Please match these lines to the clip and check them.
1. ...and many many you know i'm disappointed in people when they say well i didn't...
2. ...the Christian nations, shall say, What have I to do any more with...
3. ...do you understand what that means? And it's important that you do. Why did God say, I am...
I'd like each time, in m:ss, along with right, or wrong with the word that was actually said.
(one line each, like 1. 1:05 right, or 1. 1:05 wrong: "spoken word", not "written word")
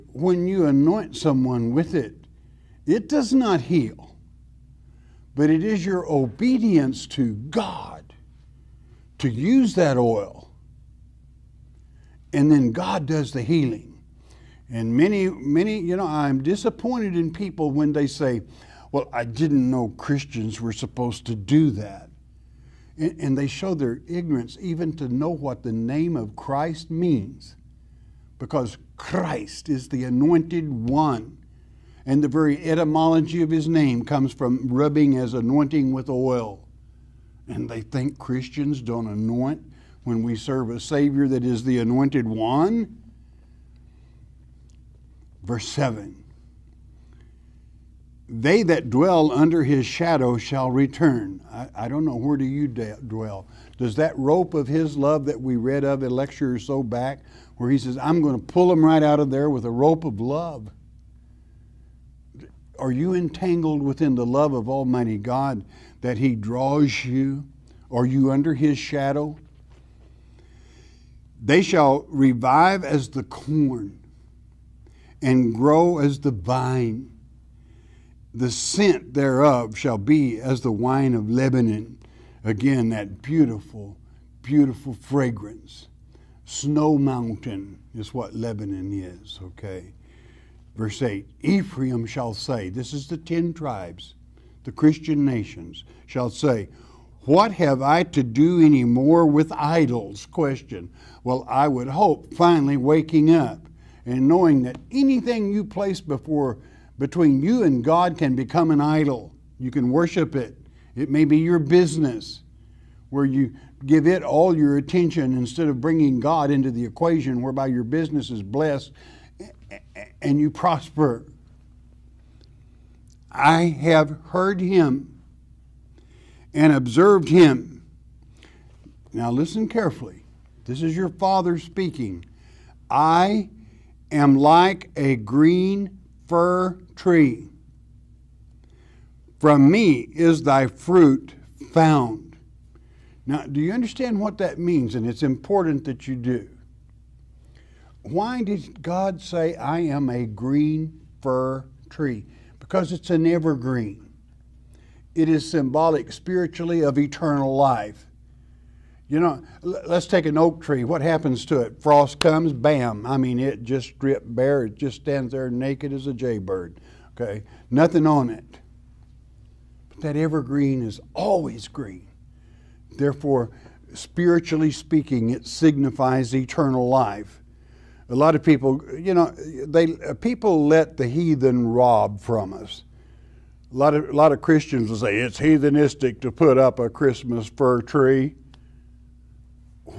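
1. 0:14 right
2. 1:34 right
3. 2:23 right.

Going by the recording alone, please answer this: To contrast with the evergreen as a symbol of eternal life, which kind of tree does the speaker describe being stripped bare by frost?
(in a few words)
Oak tree.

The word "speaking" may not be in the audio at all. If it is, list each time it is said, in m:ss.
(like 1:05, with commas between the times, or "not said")
2:11, 2:54.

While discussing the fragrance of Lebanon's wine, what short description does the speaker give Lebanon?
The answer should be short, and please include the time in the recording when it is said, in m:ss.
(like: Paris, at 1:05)
Snow Mountain, at 1:26.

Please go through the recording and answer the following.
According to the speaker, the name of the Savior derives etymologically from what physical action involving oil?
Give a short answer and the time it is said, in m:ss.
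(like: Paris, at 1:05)
Rubbing, at 0:34.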